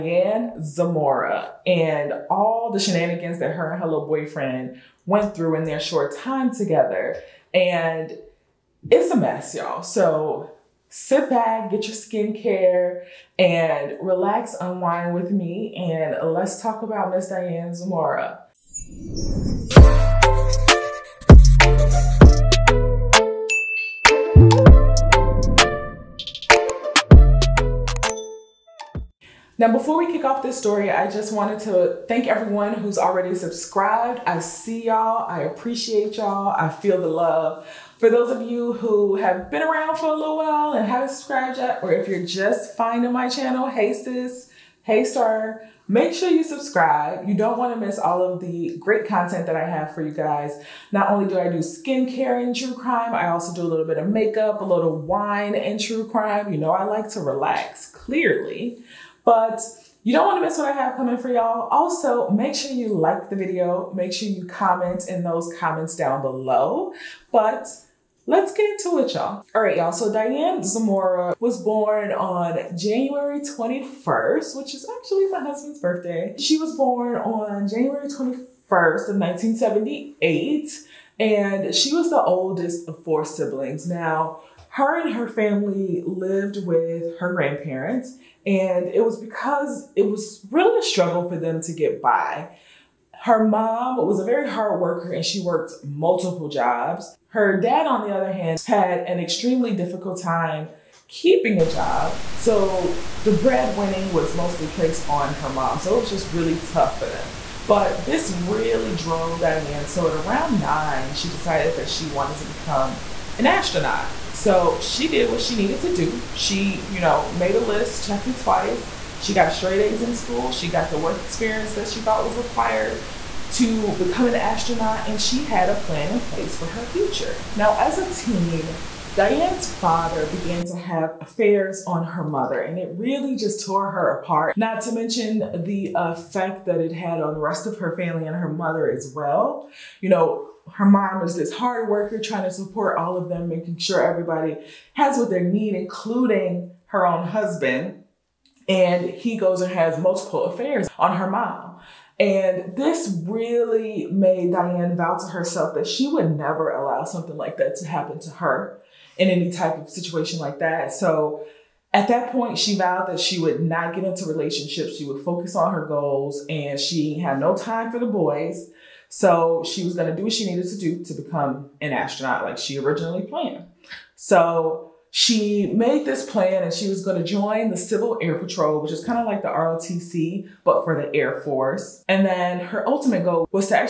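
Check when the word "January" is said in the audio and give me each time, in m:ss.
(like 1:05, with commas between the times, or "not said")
1:12, 1:17.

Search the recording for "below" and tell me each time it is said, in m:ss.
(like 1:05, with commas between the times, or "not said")
1:06.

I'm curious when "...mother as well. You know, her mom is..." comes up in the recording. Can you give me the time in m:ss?
2:18.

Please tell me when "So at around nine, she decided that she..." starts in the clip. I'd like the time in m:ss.
1:49.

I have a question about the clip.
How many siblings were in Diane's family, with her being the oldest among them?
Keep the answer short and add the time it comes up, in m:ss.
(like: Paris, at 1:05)
4, at 1:23.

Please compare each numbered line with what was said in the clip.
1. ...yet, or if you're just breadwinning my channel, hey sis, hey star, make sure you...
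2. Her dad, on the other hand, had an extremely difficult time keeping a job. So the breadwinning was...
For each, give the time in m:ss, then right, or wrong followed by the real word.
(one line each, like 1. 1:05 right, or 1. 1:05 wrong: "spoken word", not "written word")
1. 0:41 wrong: "finding", not "breadwinning"
2. 1:37 right.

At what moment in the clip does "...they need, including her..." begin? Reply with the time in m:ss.
2:25.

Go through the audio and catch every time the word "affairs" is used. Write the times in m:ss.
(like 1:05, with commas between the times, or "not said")
2:11, 2:30.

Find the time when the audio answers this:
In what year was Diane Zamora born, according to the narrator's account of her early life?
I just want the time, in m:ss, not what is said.
1:19.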